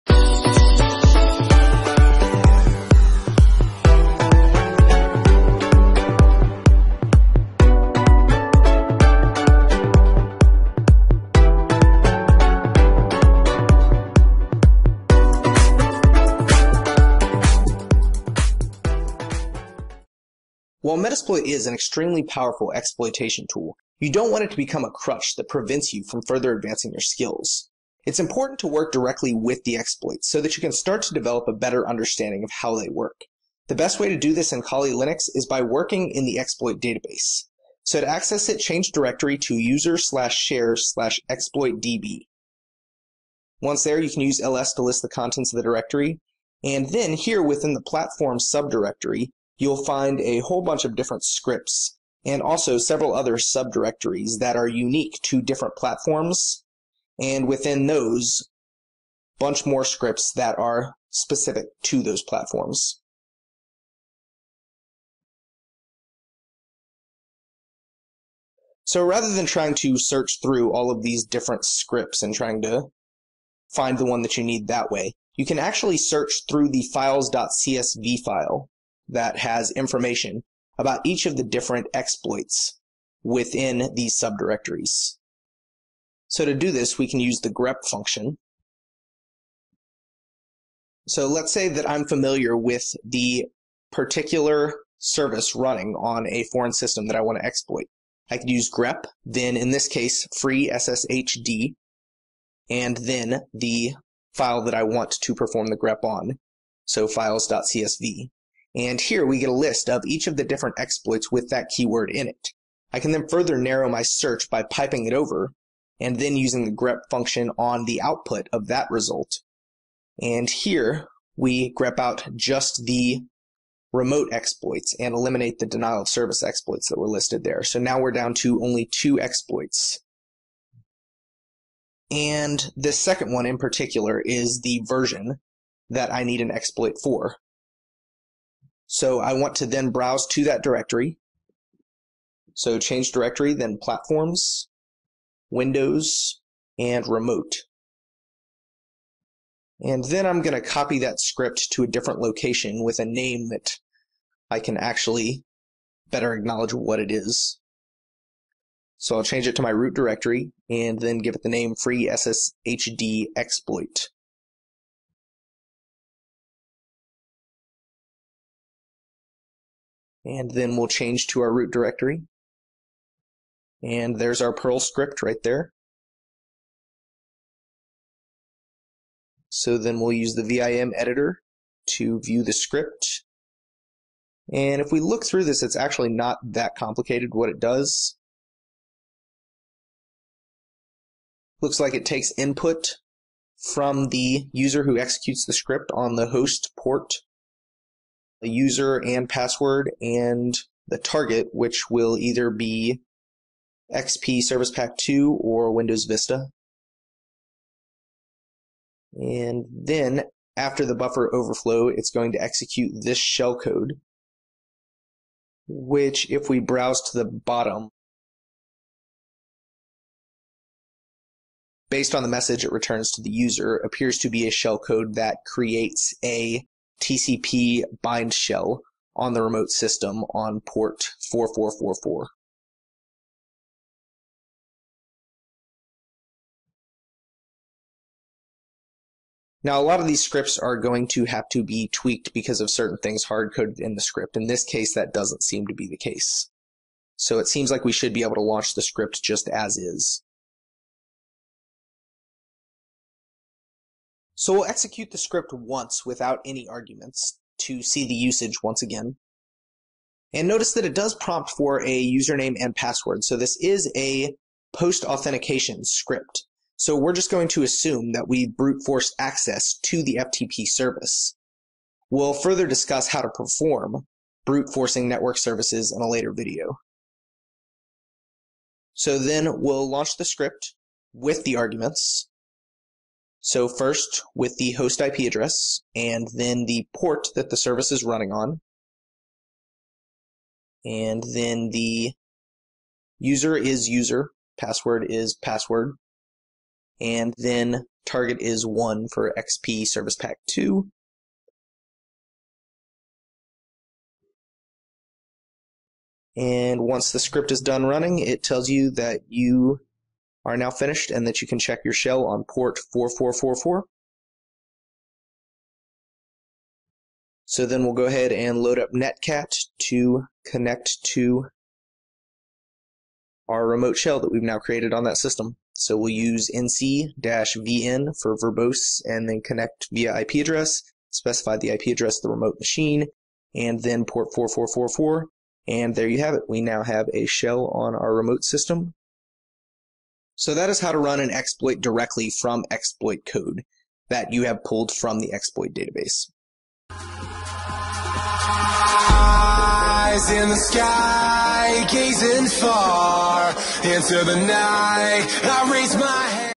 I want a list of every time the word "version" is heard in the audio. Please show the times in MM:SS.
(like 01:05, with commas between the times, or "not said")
02:14.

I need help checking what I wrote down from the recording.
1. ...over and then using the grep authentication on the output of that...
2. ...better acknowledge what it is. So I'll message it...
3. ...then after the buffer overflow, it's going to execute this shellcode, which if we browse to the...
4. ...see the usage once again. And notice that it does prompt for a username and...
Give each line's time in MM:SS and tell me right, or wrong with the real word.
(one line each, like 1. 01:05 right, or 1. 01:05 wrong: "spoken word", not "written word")
1. 01:55 wrong: "function", not "authentication"
2. 02:36 wrong: "change", not "message"
3. 03:29 right
4. 04:17 right.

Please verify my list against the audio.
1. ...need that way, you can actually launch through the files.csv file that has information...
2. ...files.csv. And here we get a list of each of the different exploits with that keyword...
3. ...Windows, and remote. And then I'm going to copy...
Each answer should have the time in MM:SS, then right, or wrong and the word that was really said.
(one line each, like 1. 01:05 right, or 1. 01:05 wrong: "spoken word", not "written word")
1. 01:14 wrong: "search", not "launch"
2. 01:47 right
3. 02:25 right.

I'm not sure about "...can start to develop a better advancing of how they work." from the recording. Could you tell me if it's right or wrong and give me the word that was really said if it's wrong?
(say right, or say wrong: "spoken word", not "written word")
wrong: "understanding", not "advancing".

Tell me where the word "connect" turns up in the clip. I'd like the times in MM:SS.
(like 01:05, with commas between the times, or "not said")
05:20, 05:29.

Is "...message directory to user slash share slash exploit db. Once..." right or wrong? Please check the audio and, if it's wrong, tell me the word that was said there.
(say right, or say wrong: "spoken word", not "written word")
wrong: "change", not "message".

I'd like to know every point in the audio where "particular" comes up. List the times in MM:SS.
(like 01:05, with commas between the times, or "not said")
01:33, 02:13.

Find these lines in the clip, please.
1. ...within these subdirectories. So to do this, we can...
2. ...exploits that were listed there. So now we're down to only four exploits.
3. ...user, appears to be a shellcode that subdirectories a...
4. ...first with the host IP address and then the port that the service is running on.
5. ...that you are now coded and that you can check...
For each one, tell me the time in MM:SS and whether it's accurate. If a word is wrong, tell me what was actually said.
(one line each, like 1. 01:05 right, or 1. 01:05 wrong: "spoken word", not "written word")
1. 01:23 right
2. 02:06 wrong: "two", not "four"
3. 03:43 wrong: "creates", not "subdirectories"
4. 04:43 right
5. 05:08 wrong: "finished", not "coded".